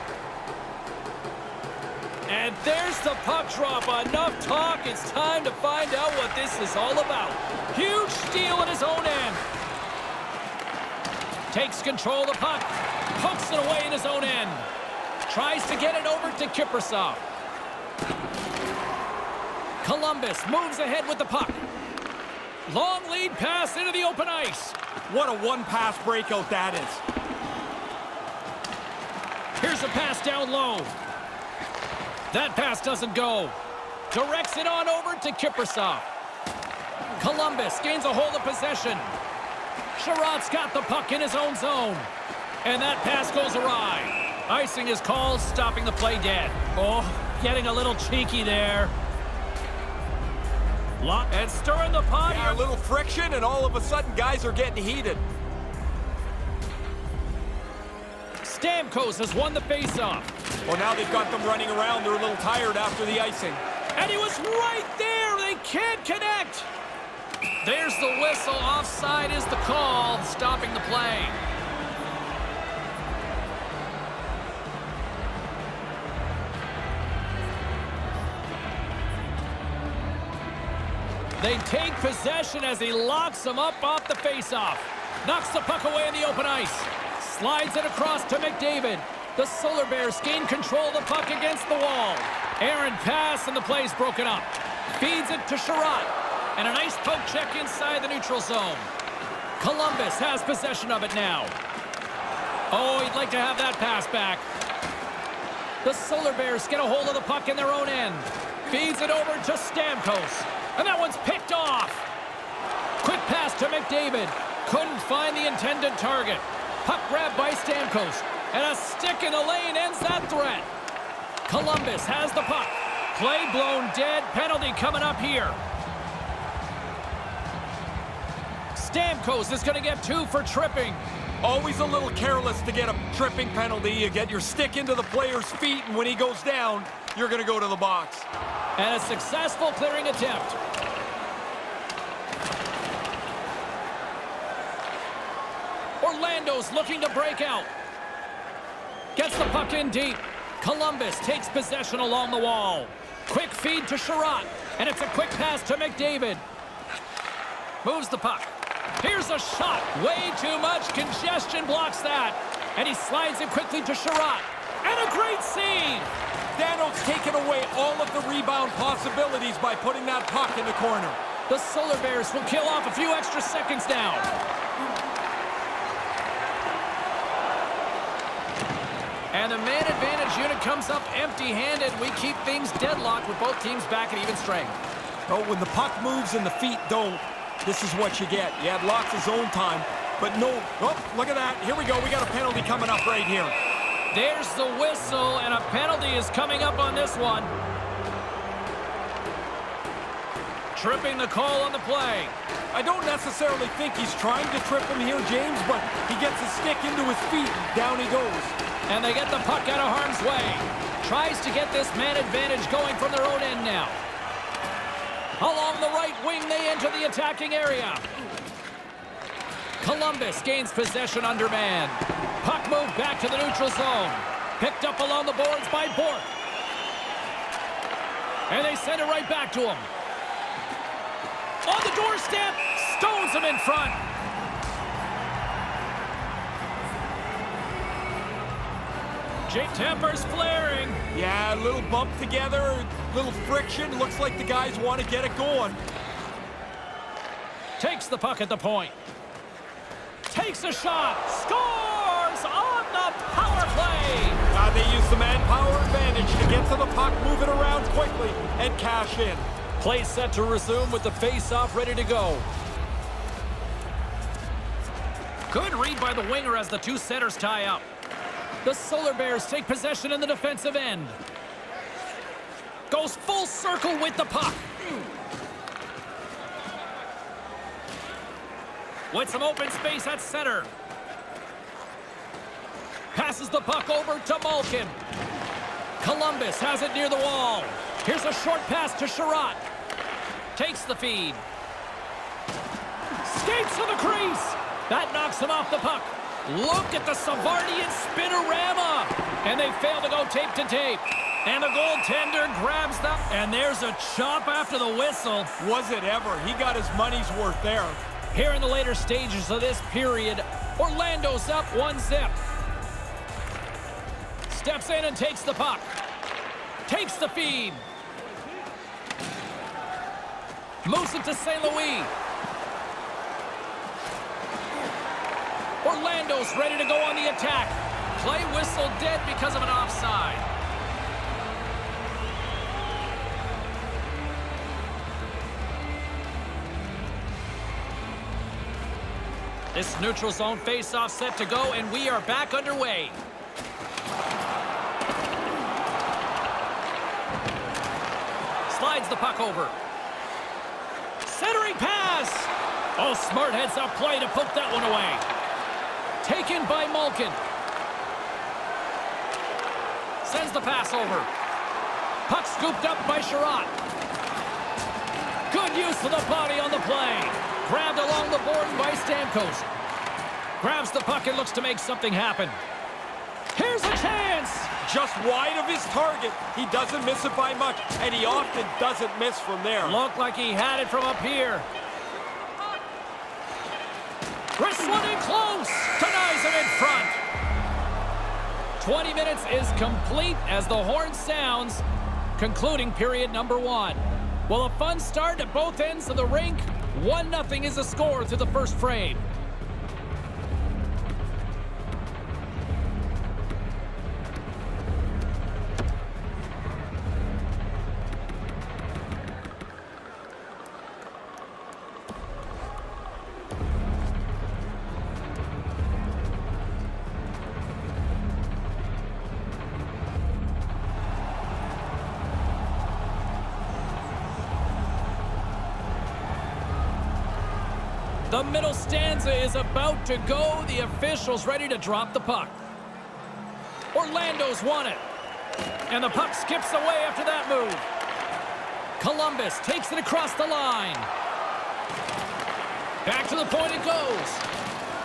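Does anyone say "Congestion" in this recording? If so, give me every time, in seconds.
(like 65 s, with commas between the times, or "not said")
160 s.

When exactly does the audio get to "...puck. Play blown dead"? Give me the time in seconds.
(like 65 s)
122 s.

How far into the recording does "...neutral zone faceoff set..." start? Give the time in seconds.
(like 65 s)
340 s.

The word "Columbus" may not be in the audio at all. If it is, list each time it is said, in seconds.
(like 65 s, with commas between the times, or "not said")
19 s, 37 s, 99 s, 121 s, 150 s, 219 s, 286 s, 438 s.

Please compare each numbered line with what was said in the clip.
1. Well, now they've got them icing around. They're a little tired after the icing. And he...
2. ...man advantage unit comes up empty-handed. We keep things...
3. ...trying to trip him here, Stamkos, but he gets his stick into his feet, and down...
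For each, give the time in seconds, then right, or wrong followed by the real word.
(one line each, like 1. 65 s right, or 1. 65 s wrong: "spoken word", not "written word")
1. 60 s wrong: "running", not "icing"
2. 179 s right
3. 204 s wrong: "James", not "Stamkos".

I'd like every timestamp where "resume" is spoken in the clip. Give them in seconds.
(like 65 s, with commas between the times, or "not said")
260 s.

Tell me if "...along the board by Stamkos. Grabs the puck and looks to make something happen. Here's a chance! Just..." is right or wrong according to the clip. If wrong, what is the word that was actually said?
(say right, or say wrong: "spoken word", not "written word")
right.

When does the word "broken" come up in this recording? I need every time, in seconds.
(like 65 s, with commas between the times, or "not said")
93 s.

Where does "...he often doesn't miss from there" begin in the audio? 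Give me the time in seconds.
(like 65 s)
378 s.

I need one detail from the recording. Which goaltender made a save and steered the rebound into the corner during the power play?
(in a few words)
Dano.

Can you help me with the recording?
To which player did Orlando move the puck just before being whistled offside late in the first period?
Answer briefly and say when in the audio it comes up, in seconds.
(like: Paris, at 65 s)
St. Louis, at 321 s.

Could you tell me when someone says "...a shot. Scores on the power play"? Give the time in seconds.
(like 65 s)
250 s.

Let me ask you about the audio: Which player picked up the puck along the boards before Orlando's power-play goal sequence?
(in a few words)
Bork.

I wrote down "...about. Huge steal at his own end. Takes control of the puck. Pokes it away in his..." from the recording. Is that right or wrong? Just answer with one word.
right.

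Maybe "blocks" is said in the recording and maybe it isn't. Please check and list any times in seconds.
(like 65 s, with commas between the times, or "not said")
161 s.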